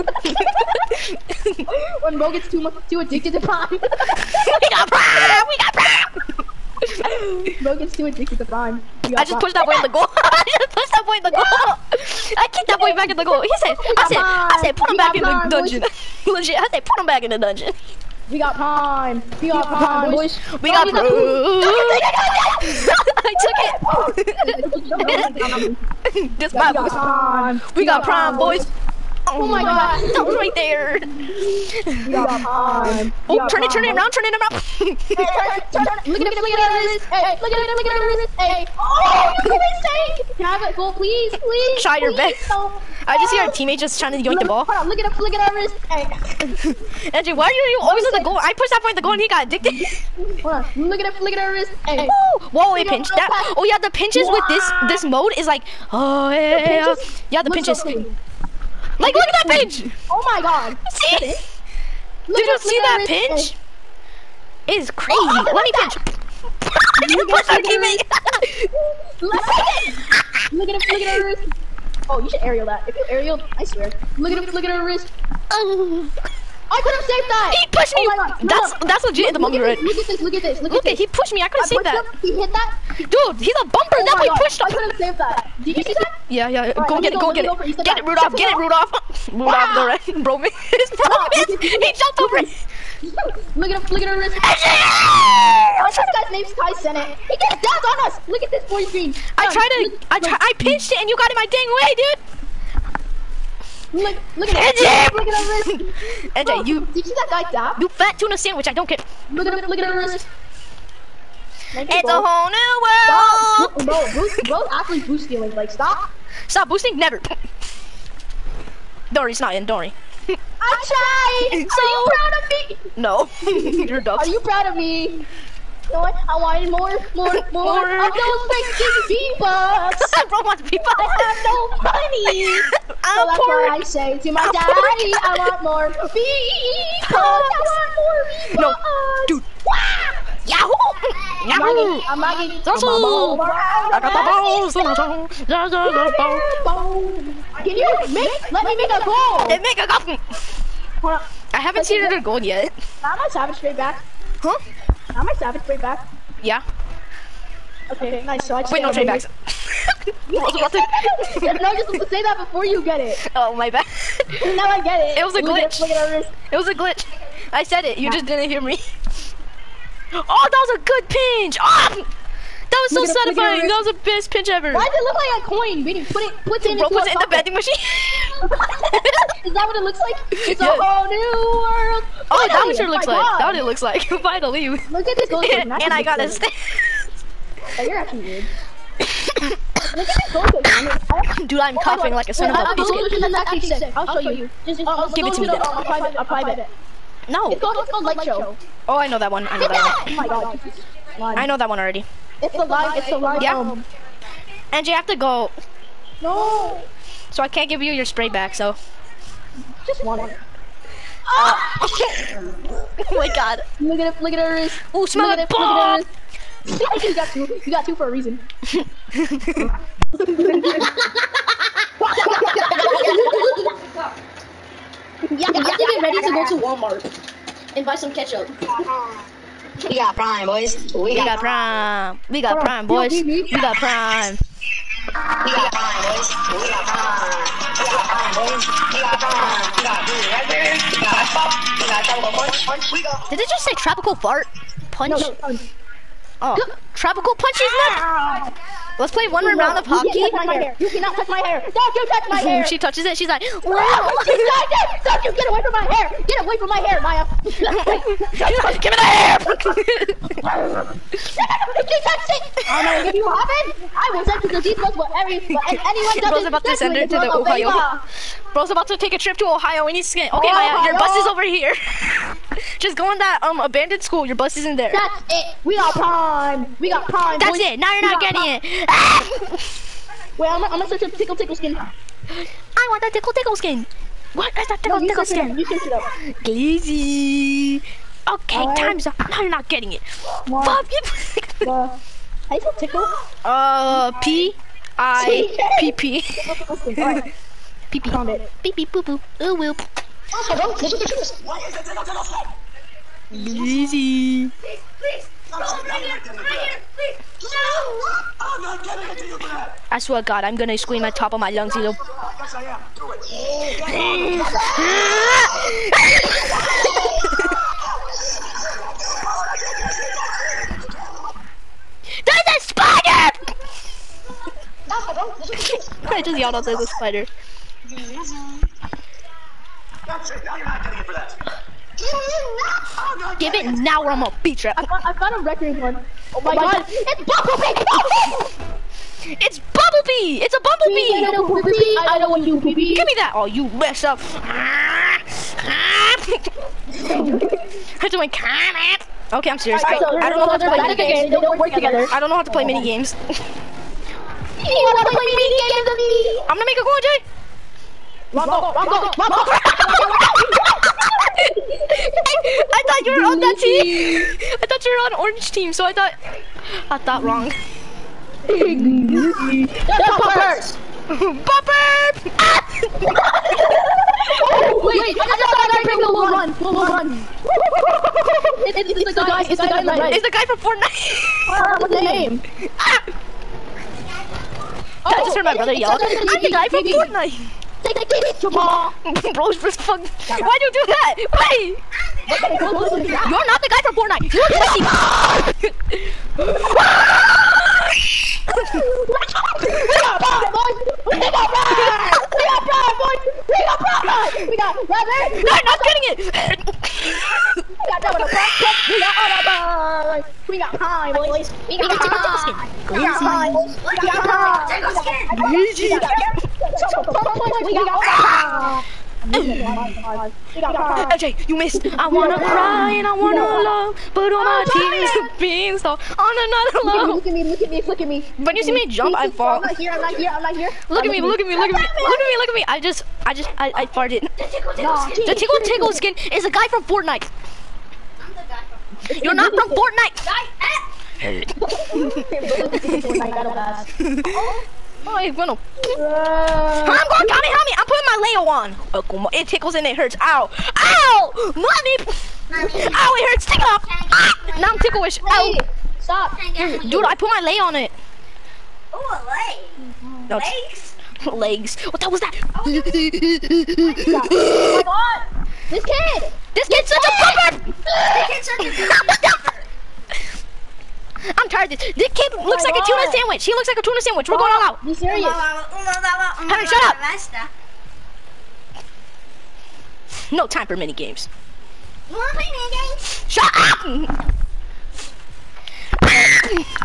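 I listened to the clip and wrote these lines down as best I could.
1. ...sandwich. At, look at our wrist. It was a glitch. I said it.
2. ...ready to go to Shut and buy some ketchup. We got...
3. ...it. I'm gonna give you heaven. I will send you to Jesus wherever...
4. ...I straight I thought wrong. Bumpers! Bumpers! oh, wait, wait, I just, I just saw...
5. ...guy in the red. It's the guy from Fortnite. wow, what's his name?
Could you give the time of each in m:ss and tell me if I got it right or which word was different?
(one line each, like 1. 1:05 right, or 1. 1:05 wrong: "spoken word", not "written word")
1. 2:45 wrong: "glitch", not "sandwich"
2. 3:46 wrong: "Walmart", not "Shut"
3. 4:22 right
4. 6:05 wrong: "thought", not "straight"
5. 6:19 right.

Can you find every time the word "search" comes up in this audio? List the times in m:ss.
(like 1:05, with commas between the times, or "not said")
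4:40, 4:45.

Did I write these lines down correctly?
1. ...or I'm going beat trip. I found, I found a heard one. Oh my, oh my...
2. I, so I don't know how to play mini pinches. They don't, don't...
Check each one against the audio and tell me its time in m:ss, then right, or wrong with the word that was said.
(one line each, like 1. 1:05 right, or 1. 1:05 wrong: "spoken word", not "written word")
1. 5:34 wrong: "record", not "heard"
2. 5:49 wrong: "games", not "pinches".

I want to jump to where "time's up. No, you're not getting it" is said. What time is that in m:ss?
4:48.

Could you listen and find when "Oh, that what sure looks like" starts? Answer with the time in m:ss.
3:02.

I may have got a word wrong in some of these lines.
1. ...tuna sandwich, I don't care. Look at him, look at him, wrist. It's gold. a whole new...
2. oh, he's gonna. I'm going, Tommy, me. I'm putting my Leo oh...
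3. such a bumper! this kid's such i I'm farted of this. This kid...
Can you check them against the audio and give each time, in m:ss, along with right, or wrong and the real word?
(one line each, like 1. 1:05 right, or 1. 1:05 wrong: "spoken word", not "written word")
1. 1:48 right
2. 7:21 right
3. 7:47 wrong: "tired", not "farted".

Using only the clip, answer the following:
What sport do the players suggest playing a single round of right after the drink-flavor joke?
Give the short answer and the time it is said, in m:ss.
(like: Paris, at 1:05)
hockey, at 4:09.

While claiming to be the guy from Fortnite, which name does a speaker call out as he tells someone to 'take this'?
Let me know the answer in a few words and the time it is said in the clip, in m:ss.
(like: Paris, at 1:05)
Jamal, at 6:28.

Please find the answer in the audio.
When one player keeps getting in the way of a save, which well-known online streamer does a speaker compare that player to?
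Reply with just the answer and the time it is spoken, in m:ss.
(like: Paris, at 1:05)
Kai Cenat, at 1:36.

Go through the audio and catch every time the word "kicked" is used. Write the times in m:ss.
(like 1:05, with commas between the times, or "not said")
0:12.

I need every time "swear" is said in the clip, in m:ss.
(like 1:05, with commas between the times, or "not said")
1:13, 5:09.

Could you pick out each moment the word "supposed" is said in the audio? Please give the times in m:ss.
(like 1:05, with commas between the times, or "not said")
2:41.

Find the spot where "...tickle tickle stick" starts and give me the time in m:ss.
5:01.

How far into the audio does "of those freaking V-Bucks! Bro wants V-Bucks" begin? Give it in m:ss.
2:08.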